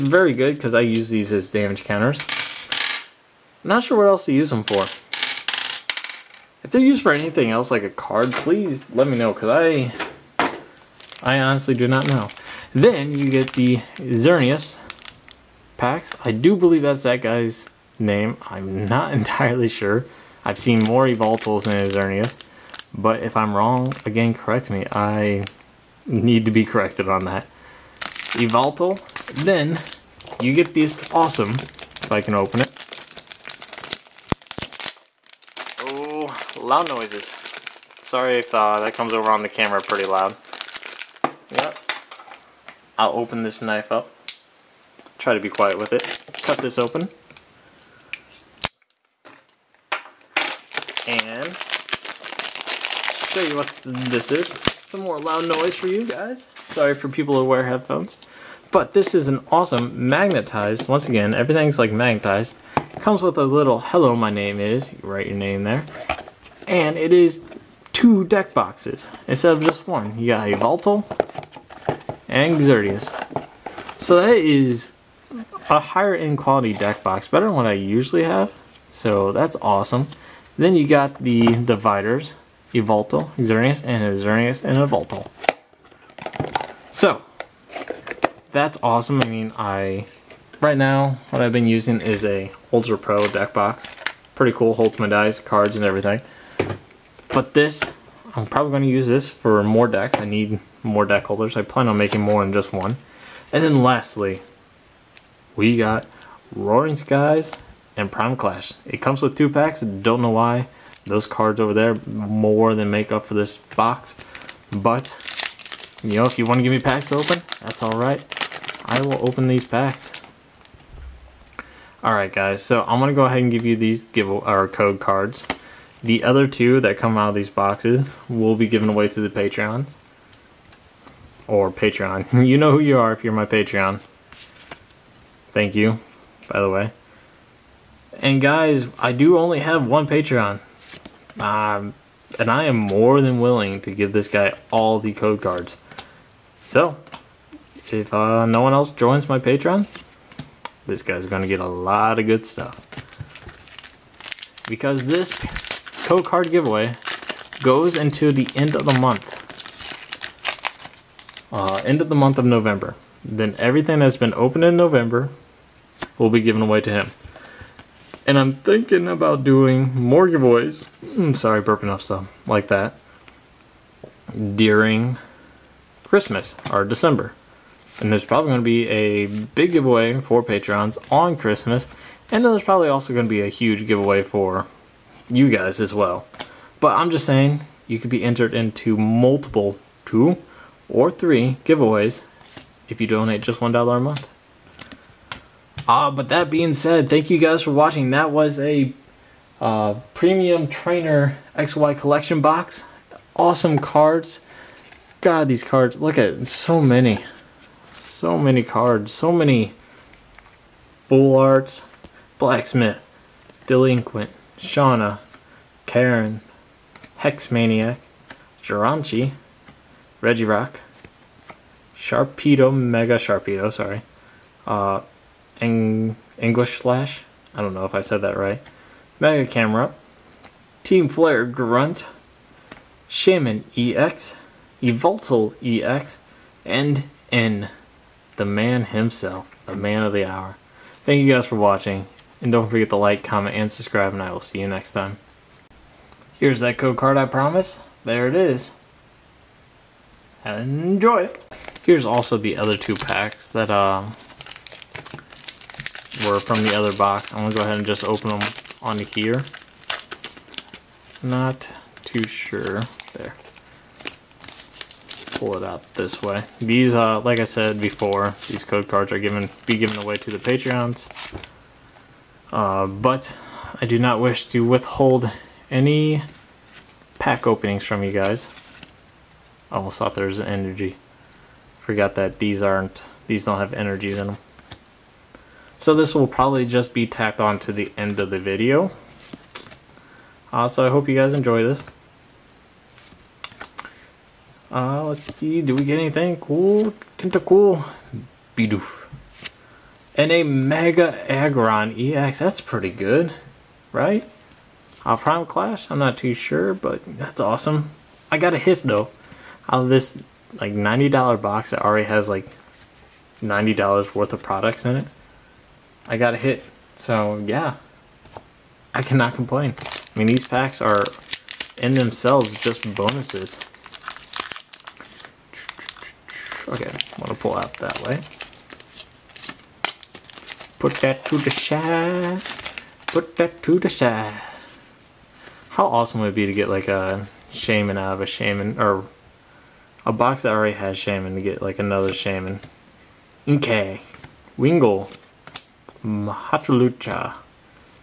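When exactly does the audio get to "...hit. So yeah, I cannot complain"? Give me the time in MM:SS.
05:16.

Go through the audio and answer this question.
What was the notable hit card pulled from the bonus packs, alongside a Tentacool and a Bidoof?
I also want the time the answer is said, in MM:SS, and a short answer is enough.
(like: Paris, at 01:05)
Mega Aggron EX, at 05:00.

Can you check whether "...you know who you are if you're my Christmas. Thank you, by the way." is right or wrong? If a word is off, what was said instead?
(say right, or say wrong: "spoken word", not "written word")
wrong: "Patreon", not "Christmas".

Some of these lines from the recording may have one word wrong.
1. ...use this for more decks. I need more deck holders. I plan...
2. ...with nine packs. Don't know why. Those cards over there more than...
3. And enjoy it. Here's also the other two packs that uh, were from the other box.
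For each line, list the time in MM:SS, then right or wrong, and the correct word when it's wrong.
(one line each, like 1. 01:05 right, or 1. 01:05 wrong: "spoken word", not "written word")
1. 01:38 right
2. 01:49 wrong: "two", not "nine"
3. 04:10 right.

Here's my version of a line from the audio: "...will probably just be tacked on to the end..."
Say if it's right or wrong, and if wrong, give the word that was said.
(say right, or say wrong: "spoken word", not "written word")
right.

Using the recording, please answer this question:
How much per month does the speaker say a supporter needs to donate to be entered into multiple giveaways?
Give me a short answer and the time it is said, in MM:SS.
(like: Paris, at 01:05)
$1, at 03:13.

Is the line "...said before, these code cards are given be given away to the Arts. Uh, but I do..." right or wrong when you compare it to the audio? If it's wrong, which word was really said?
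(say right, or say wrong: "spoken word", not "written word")
wrong: "Patreons", not "Arts".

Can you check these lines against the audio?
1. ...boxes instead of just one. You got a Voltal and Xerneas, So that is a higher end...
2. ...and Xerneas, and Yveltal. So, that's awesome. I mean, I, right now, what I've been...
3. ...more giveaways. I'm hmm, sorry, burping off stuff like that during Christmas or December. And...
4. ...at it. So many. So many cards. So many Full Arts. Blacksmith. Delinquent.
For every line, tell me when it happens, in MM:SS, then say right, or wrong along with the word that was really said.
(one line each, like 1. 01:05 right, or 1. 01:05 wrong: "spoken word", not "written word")
1. 01:08 right
2. 01:23 right
3. 02:49 right
4. 03:26 right.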